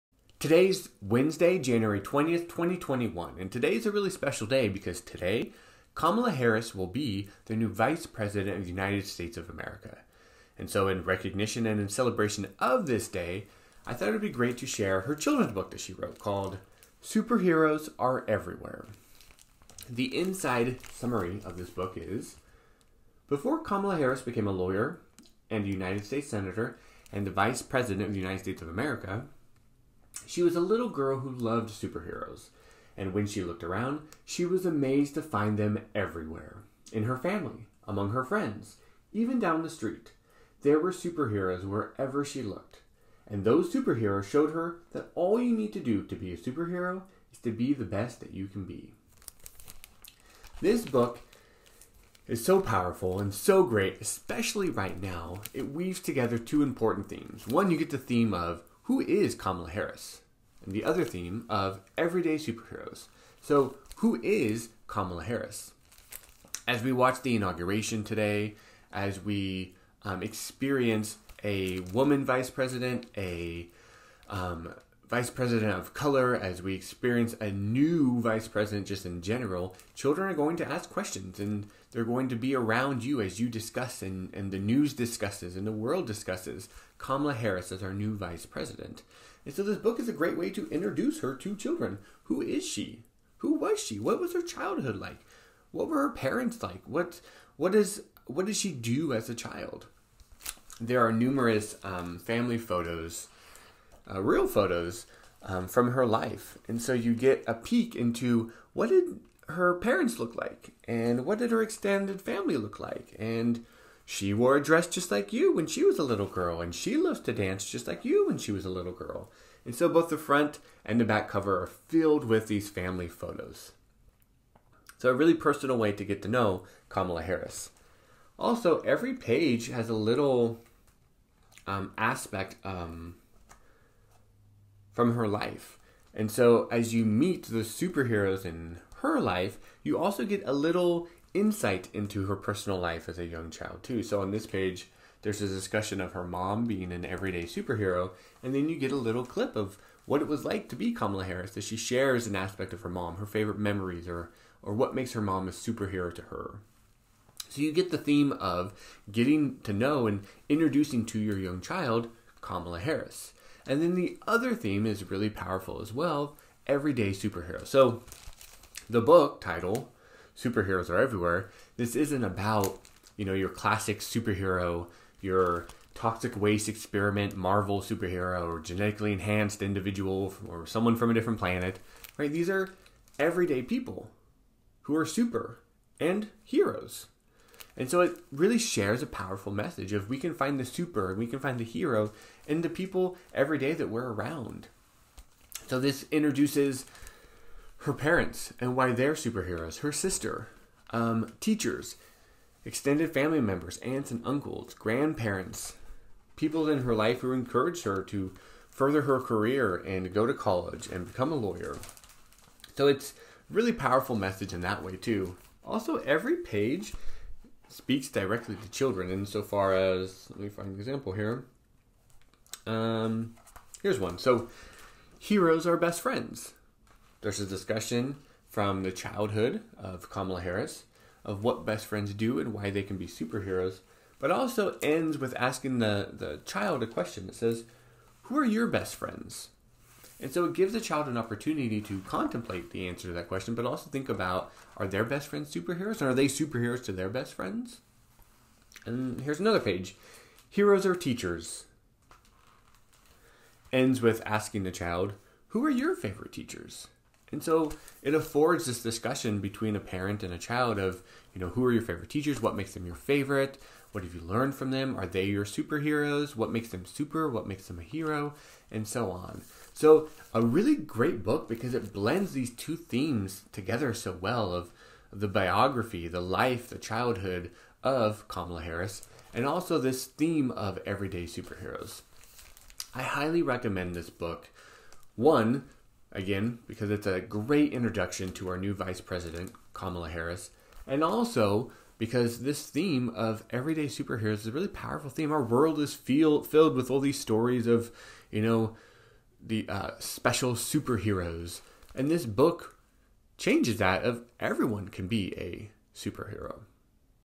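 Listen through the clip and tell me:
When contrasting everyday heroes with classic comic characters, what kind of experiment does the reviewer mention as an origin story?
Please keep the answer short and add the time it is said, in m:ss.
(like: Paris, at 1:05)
toxic waste experiment, at 2:55.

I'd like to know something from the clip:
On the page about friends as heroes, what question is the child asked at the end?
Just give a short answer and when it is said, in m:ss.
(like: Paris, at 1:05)
Who are your best friends?, at 3:58.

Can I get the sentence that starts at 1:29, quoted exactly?
And so this book is a great way to introduce her to children.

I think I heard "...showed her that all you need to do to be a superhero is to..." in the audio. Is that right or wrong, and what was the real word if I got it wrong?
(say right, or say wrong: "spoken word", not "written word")
right.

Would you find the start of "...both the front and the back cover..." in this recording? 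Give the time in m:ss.
1:59.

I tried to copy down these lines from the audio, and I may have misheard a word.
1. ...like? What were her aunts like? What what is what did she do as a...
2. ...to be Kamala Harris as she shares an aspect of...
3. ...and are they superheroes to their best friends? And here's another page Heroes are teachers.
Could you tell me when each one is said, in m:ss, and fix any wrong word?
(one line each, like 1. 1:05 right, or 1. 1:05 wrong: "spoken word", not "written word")
1. 1:34 wrong: "parents", not "aunts"
2. 2:30 right
3. 4:05 right.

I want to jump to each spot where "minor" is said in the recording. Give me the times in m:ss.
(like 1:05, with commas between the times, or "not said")
not said.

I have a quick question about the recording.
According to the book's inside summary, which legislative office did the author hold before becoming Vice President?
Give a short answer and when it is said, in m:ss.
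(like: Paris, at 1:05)
United States Senator, at 0:25.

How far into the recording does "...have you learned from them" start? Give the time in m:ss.
4:24.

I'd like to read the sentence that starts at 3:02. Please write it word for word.
These are everyday people who are super and heroes.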